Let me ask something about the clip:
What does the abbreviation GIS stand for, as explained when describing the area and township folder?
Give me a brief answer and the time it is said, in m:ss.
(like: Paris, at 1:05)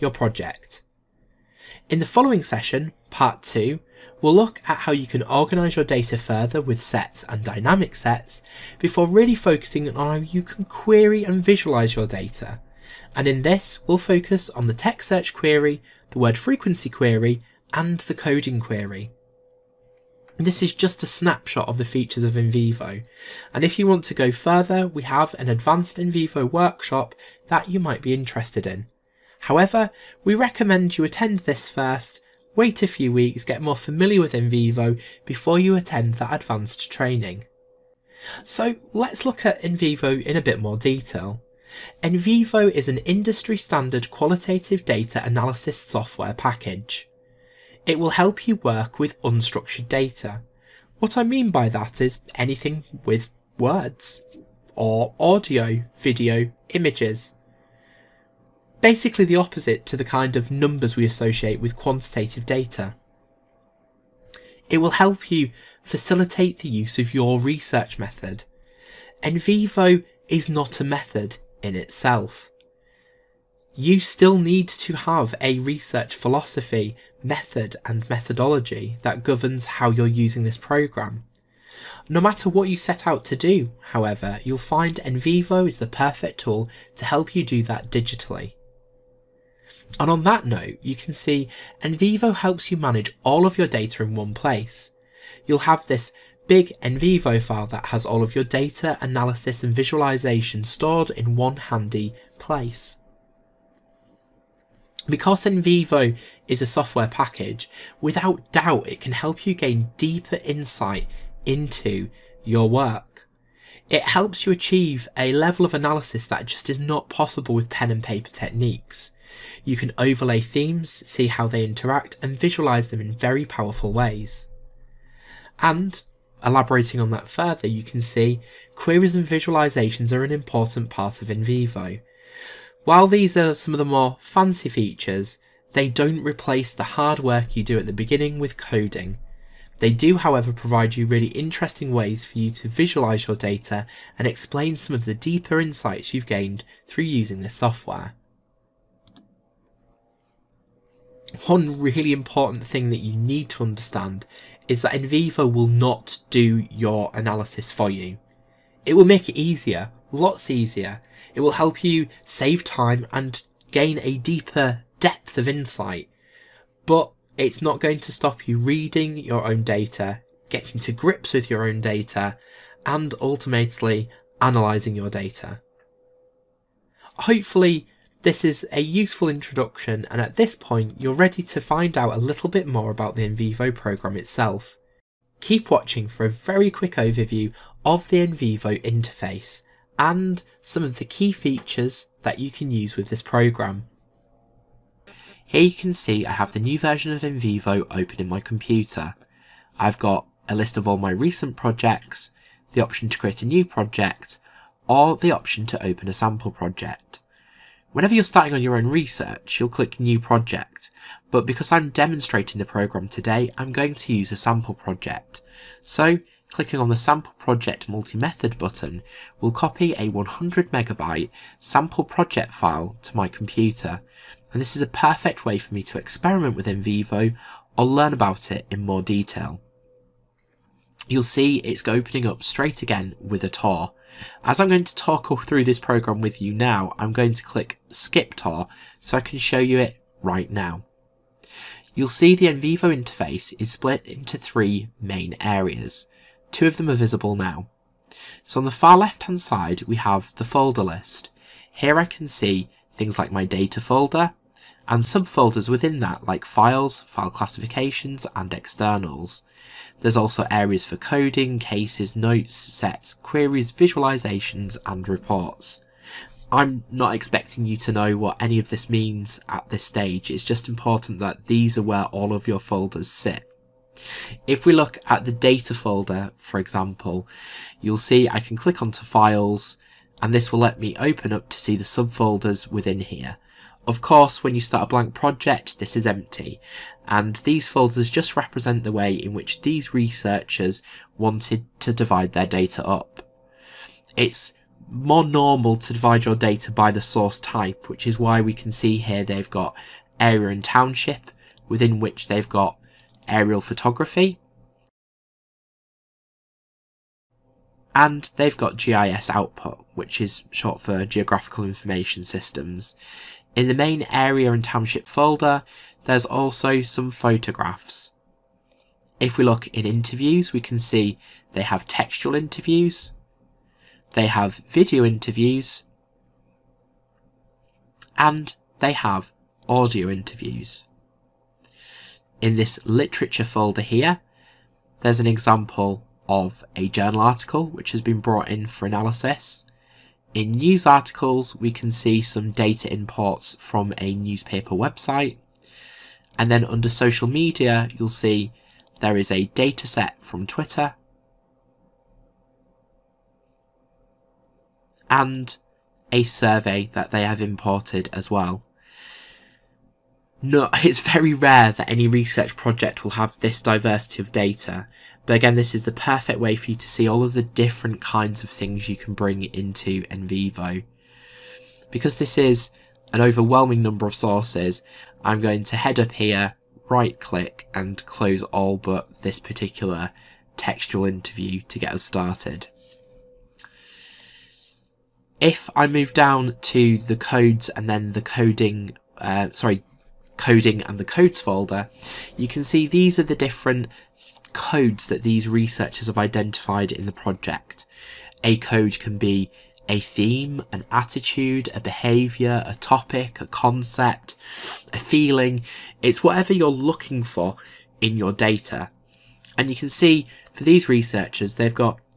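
Geographical Information Systems, at 5:11.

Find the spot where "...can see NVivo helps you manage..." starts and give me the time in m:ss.
1:30.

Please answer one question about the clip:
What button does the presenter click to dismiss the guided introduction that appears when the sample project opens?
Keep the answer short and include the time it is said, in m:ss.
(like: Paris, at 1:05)
Skip Tour, at 3:57.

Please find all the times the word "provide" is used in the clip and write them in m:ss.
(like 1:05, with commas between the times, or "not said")
2:20.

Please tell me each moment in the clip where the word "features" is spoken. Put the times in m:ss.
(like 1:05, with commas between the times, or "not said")
0:21, 2:14, 3:11.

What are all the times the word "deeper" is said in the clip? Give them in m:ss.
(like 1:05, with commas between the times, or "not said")
1:49, 2:25, 2:44.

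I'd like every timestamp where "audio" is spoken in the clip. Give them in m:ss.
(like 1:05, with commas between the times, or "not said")
0:55, 5:29.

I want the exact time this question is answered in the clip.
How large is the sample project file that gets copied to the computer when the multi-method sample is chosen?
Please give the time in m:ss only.
3:40.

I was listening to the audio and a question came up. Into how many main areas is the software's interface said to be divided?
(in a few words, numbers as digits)
3.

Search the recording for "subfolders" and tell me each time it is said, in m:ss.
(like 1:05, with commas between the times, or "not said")
4:15, 4:41.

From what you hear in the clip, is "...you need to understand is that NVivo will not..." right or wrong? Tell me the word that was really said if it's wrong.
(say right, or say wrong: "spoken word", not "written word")
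right.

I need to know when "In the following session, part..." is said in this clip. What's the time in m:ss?
0:01.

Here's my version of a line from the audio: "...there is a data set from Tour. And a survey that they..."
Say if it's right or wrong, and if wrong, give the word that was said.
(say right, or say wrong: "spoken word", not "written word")
wrong: "Twitter", not "Tour".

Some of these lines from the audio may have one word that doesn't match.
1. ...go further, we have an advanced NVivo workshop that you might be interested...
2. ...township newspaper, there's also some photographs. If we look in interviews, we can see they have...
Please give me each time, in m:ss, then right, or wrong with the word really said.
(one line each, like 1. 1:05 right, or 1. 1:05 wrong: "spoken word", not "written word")
1. 0:24 right
2. 5:14 wrong: "folder", not "newspaper".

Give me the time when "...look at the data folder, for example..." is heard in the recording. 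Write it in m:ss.
4:34.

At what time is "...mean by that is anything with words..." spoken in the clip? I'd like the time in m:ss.
0:51.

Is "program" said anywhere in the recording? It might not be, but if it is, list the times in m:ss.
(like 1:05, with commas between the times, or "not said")
1:20, 3:03, 3:13, 3:32, 3:55.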